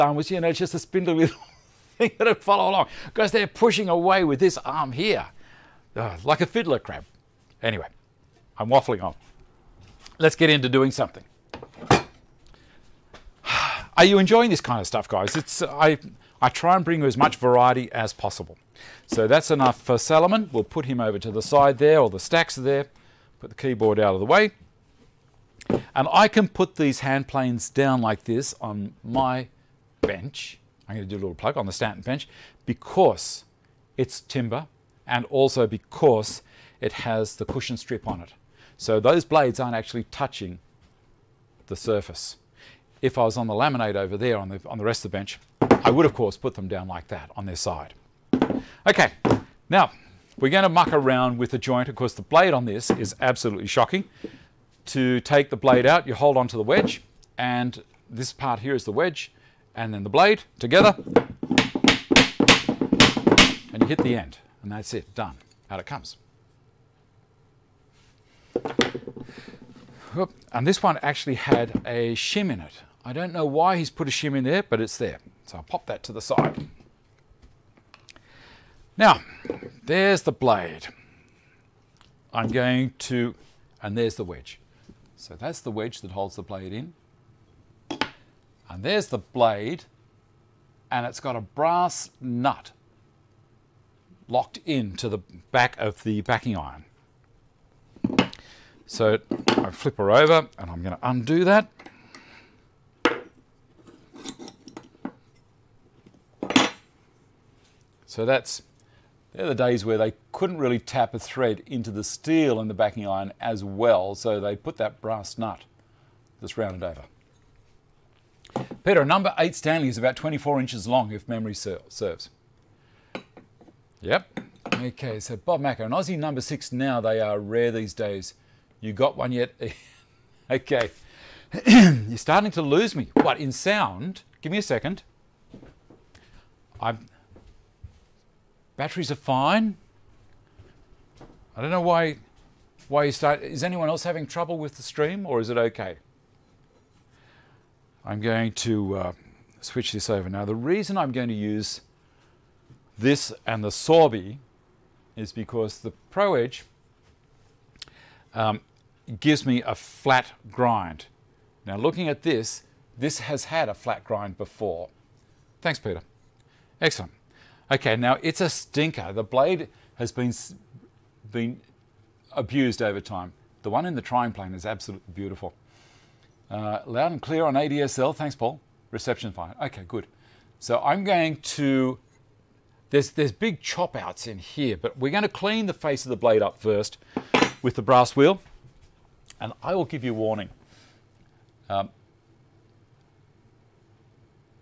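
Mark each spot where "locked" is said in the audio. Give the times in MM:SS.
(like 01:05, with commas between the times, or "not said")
01:34.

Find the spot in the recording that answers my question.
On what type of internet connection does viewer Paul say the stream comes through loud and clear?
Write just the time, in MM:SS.
02:57.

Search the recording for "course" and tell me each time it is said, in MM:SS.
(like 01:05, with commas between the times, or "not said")
00:46, 00:51.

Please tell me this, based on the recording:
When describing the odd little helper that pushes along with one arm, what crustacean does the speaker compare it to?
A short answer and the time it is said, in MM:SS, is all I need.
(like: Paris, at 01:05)
fiddler crab, at 00:06.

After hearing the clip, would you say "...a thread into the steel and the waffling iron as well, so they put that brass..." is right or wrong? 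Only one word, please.
wrong.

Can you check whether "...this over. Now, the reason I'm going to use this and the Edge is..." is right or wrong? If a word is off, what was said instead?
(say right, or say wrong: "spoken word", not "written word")
wrong: "Sorby", not "Edge".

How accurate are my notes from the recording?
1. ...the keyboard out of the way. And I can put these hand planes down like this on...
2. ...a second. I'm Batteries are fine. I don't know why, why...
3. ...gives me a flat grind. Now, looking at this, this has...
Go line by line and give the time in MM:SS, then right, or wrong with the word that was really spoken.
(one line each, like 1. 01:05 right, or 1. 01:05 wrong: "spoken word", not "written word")
1. 00:23 right
2. 02:14 right
3. 02:39 right.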